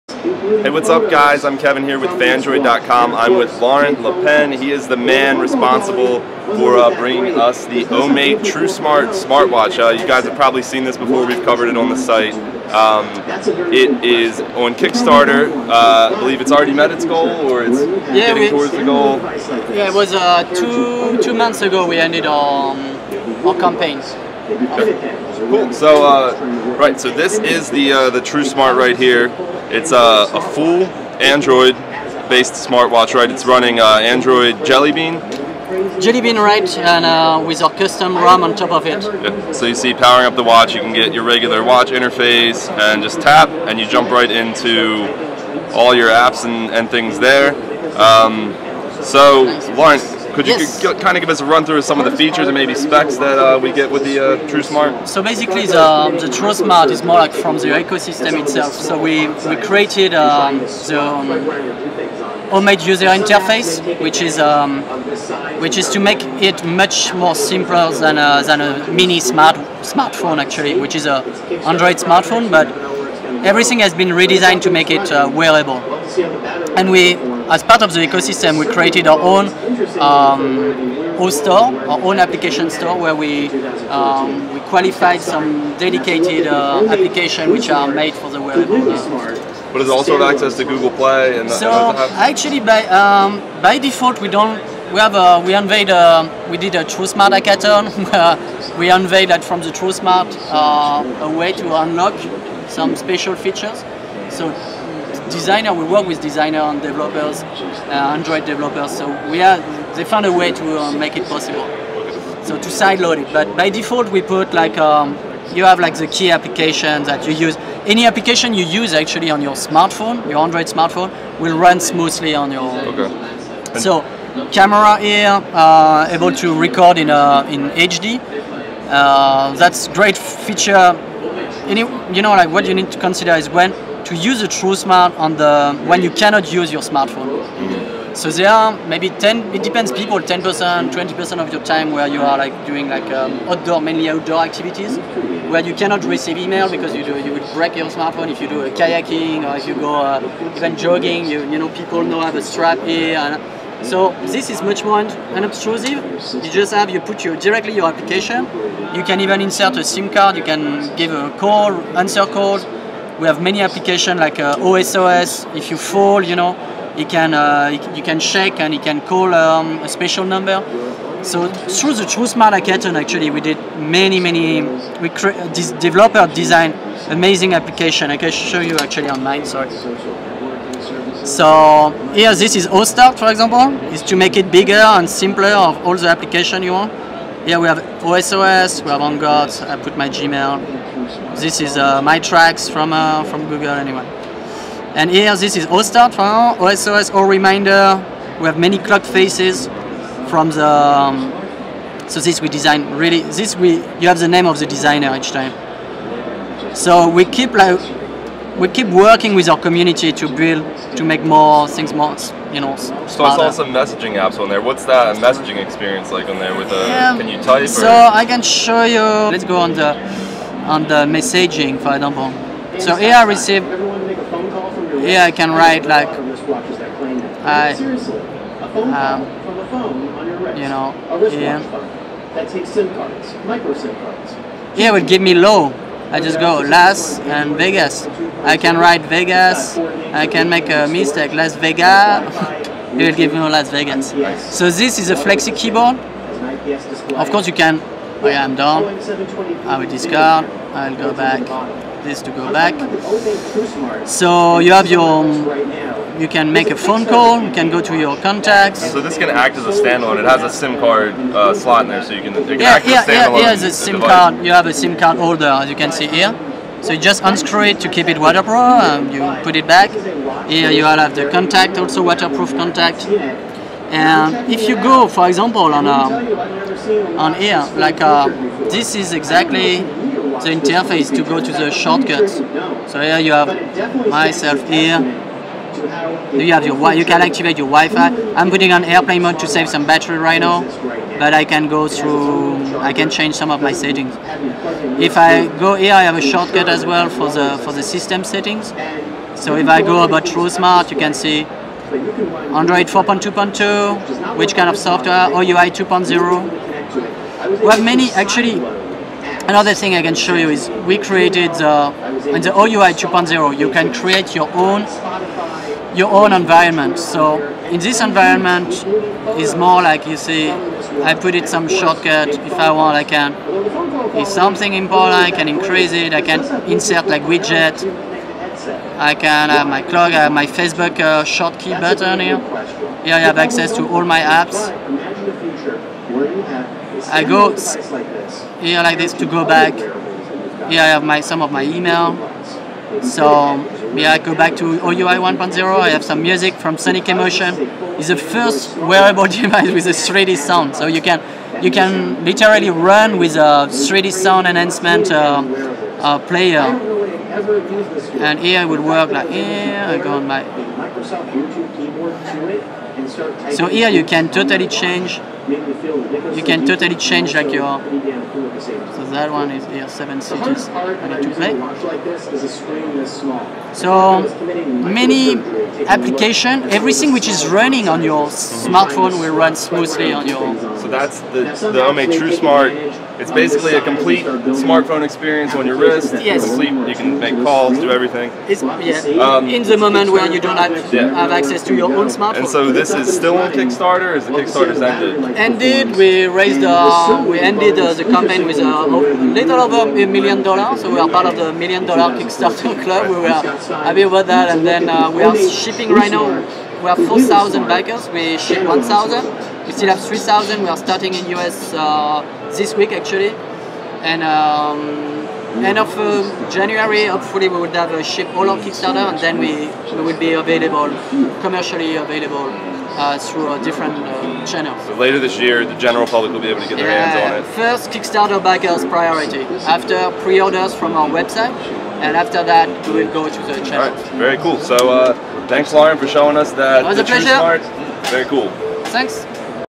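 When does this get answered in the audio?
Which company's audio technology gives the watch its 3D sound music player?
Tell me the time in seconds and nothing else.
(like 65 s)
346 s.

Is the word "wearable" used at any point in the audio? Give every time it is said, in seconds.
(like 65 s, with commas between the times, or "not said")
75 s, 88 s, 348 s.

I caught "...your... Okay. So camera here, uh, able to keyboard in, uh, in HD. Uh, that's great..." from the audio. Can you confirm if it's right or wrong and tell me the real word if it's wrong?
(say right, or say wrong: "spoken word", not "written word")
wrong: "record", not "keyboard".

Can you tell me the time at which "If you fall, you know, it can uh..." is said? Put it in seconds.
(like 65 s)
165 s.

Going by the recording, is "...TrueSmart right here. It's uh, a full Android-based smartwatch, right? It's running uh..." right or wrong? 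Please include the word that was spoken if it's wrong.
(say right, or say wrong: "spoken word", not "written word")
right.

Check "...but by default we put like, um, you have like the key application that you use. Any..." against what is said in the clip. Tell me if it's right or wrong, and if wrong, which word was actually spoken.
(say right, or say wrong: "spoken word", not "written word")
right.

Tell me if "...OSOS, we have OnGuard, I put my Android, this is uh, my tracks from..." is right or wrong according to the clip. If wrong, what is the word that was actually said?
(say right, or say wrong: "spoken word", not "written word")
wrong: "Gmail", not "Android".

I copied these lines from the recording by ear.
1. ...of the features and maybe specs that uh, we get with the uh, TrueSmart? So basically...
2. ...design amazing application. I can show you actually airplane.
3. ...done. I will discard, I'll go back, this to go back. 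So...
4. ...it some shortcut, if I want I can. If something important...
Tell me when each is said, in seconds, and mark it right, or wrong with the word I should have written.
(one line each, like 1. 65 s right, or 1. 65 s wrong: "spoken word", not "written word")
1. 51 s right
2. 176 s wrong: "online", not "airplane"
3. 248 s right
4. 321 s right.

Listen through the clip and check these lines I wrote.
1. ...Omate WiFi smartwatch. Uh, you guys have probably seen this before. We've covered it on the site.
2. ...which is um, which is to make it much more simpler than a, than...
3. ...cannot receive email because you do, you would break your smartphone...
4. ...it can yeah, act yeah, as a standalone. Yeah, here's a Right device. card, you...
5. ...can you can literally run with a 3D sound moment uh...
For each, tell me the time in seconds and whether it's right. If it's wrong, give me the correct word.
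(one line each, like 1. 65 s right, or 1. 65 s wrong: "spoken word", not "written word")
1. 7 s wrong: "TrueSmart", not "WiFi"
2. 63 s right
3. 145 s right
4. 262 s wrong: "SIM", not "Right"
5. 351 s wrong: "enhancement", not "moment".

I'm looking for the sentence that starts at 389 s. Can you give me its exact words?
Um, in the moment where you don't have, yeah.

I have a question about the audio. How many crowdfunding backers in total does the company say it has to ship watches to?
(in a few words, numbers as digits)
4,000.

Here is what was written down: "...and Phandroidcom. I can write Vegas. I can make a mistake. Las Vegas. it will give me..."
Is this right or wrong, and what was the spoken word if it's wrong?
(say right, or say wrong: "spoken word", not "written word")
wrong: "Vegas", not "Phandroidcom".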